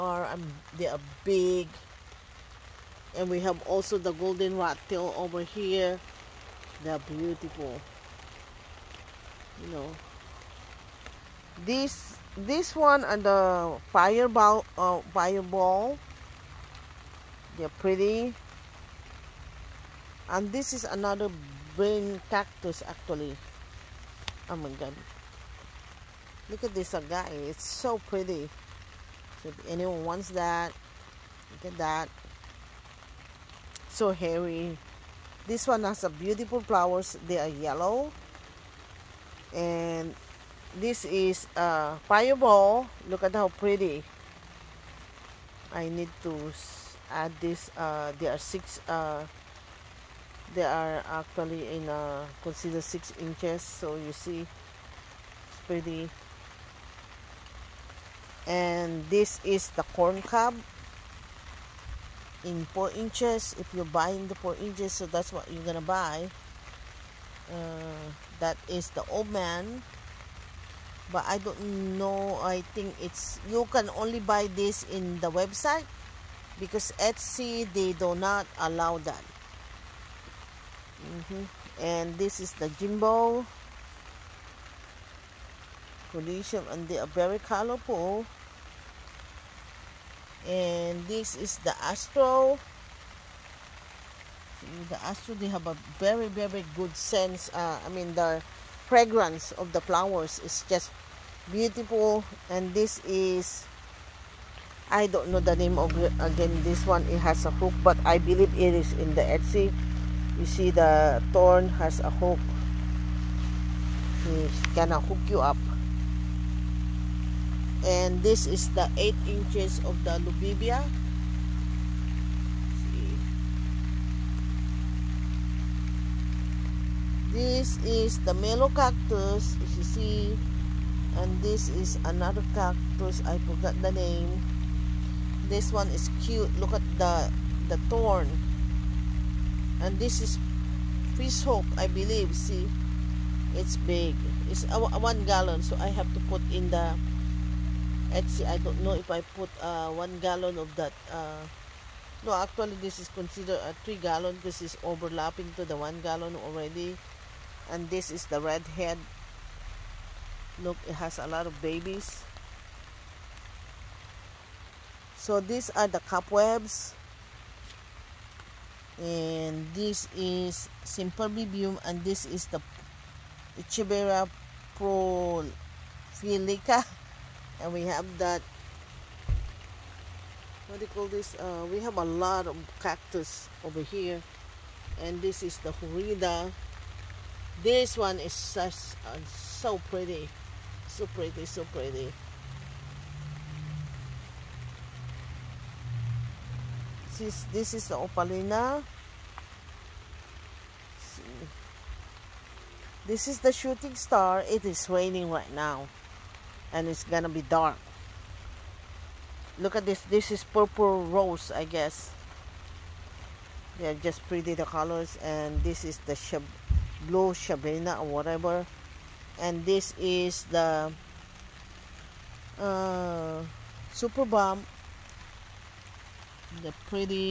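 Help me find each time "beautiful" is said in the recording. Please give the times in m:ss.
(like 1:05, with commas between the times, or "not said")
0:06, 0:36, 1:41.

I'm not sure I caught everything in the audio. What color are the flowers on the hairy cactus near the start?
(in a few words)
Yellow.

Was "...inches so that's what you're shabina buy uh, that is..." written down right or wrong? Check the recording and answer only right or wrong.
wrong.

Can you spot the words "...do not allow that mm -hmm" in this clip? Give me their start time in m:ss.
1:17.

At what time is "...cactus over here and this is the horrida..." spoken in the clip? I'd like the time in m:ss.
3:02.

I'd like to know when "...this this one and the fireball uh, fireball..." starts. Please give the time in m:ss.
0:11.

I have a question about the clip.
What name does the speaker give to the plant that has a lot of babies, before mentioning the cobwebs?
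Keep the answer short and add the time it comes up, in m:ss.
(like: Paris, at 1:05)
Red head, at 2:38.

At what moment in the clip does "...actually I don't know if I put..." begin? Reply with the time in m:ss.
2:28.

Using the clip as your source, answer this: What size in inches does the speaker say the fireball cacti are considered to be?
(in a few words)
6 inches.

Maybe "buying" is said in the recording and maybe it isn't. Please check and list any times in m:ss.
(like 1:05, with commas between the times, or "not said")
1:03.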